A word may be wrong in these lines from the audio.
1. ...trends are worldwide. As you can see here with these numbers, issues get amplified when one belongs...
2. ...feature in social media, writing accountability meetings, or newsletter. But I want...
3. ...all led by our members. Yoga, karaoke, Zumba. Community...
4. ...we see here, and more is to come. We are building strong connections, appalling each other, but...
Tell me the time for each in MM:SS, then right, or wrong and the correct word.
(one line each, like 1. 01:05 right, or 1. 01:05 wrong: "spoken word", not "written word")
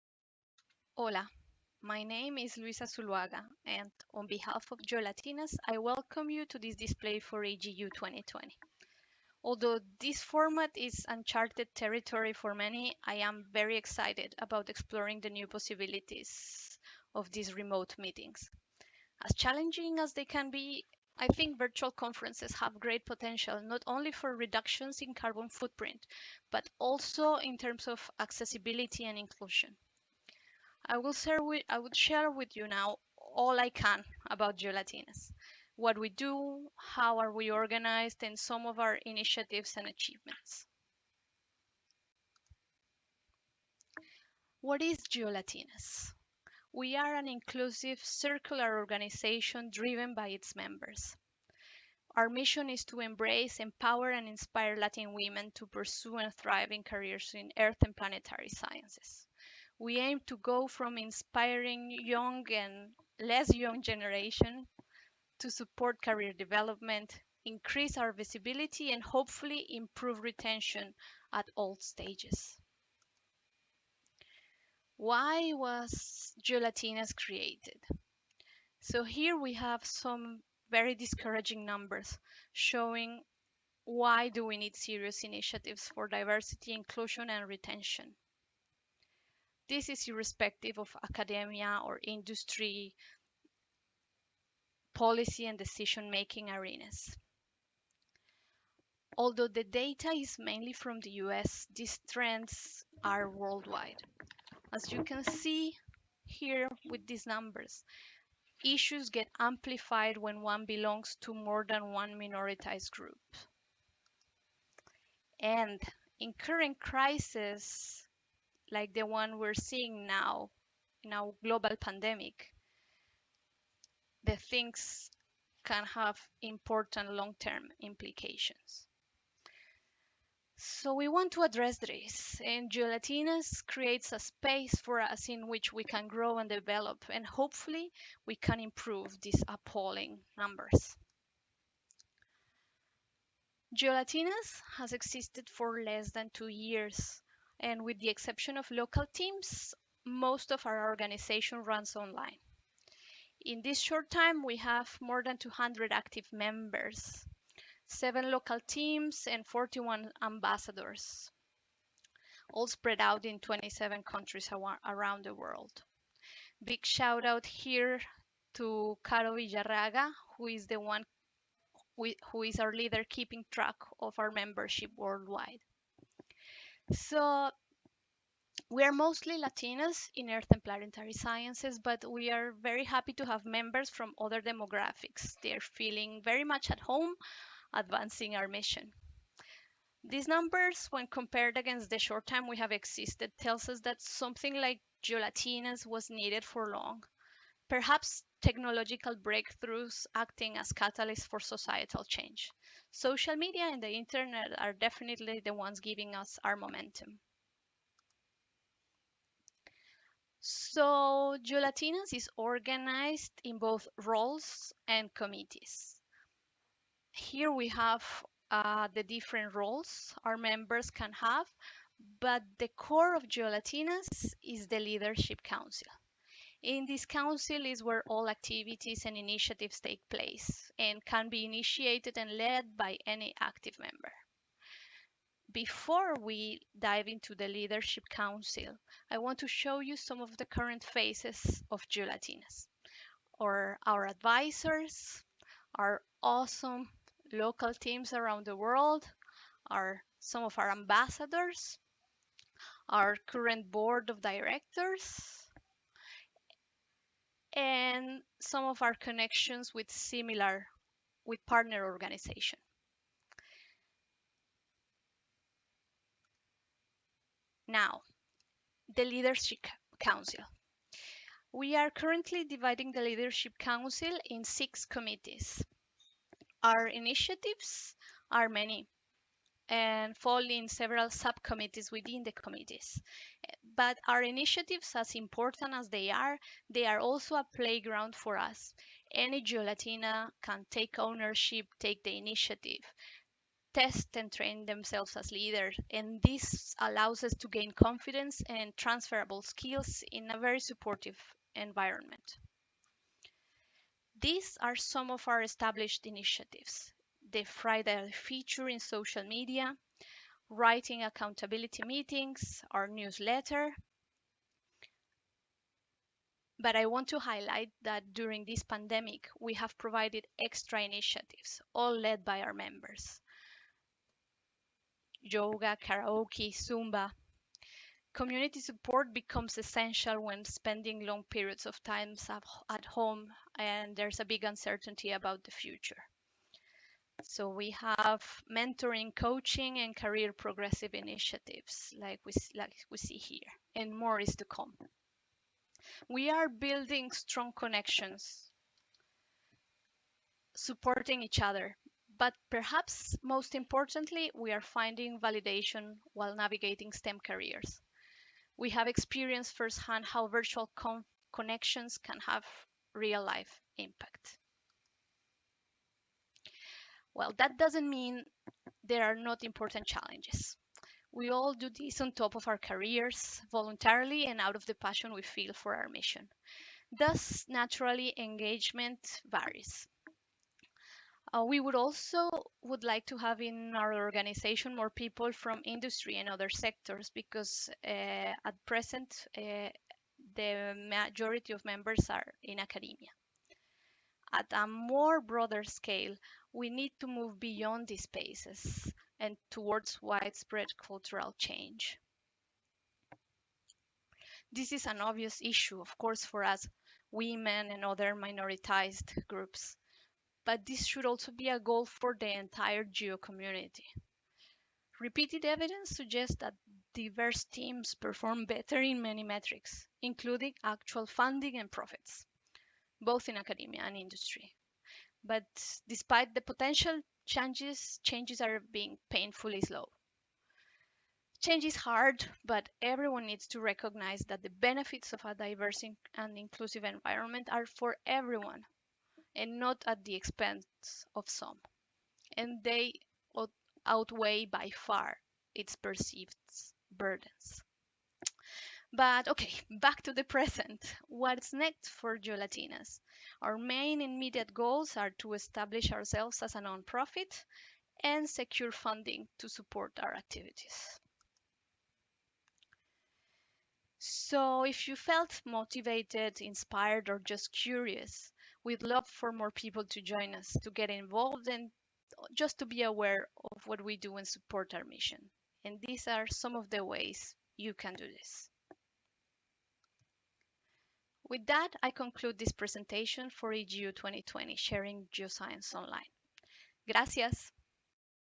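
1. 01:42 right
2. 05:08 right
3. 05:21 right
4. 05:42 wrong: "supporting", not "appalling".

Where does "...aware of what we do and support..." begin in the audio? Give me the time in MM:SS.
07:52.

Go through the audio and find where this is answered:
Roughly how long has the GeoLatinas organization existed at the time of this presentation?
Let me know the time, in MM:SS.
02:25.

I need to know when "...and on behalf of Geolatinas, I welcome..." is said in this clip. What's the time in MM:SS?
00:03.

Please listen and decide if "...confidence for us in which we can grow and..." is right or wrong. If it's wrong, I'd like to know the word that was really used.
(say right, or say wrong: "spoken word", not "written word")
wrong: "space", not "confidence".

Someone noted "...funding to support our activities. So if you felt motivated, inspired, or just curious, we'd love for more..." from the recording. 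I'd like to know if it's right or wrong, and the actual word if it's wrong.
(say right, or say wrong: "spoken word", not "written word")
right.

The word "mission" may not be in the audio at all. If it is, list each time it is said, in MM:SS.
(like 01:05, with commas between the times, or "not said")
00:52, 03:08, 06:15, 07:54.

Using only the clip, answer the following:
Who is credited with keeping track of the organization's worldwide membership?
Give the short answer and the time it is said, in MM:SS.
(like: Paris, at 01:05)
Caro Villarraga, at 02:49.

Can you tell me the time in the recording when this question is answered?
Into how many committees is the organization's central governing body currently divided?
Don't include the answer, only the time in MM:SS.
04:34.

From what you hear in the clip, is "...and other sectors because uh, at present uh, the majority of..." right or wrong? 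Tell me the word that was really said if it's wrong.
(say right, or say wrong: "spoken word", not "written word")
right.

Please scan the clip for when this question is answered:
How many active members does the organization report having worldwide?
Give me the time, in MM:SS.
02:35.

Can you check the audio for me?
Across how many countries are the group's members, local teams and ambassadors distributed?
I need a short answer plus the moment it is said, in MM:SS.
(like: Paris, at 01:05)
27, at 02:43.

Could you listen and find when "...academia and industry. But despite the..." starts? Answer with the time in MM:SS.
07:03.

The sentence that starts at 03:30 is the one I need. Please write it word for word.
So GeoLatinas is organized in both roles and committees.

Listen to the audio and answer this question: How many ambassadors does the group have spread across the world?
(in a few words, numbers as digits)
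41.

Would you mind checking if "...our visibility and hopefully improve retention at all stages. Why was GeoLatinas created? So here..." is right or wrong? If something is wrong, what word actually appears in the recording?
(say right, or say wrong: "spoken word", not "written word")
right.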